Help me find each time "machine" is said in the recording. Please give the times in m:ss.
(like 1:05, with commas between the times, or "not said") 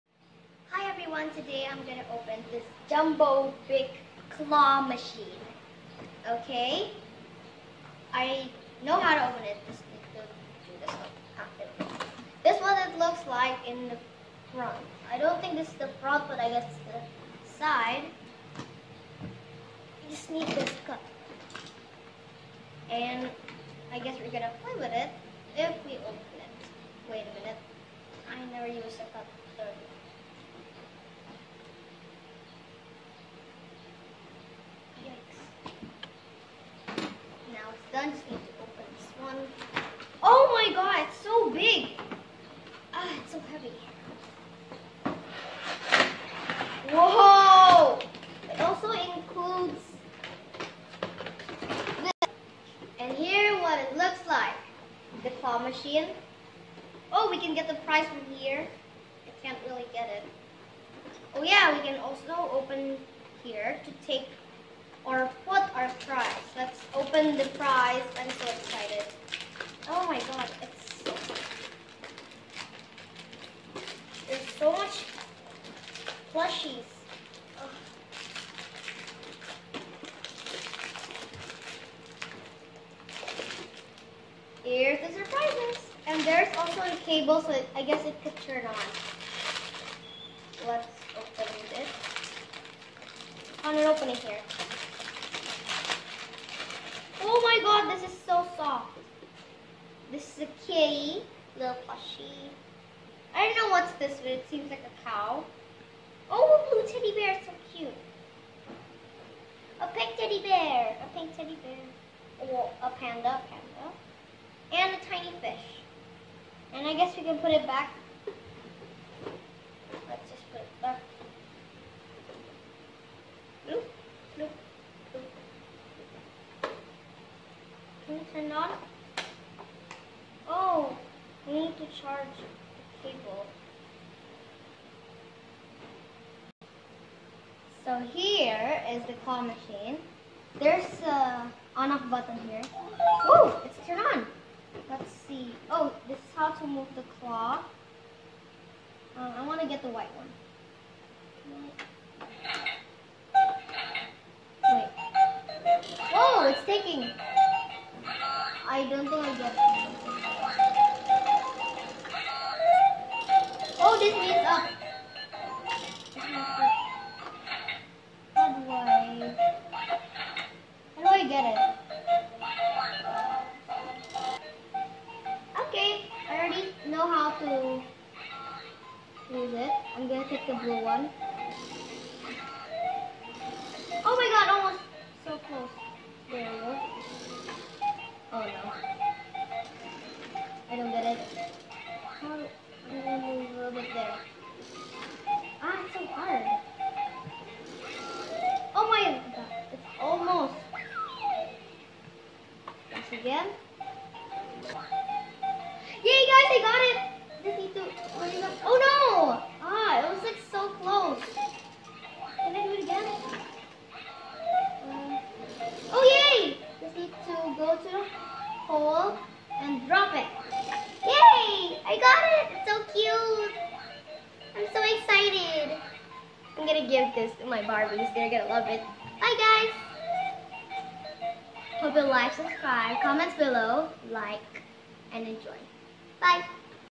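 0:04, 0:55, 2:19.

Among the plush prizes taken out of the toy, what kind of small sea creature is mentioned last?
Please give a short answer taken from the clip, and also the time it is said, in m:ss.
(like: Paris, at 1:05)
Tiny fish, at 1:55.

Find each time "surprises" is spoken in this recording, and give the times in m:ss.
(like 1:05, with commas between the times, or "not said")
1:25.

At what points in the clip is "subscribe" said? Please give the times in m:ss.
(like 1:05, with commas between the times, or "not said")
3:52.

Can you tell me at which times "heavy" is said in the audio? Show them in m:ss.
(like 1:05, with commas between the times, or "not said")
0:43.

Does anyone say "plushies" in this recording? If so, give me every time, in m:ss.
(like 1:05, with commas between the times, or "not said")
1:16, 1:41.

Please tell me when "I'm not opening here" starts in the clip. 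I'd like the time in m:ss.
1:33.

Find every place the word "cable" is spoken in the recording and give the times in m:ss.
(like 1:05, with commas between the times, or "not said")
1:27, 2:13.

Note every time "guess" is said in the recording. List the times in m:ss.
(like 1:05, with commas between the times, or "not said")
0:16, 0:23, 1:27, 1:56.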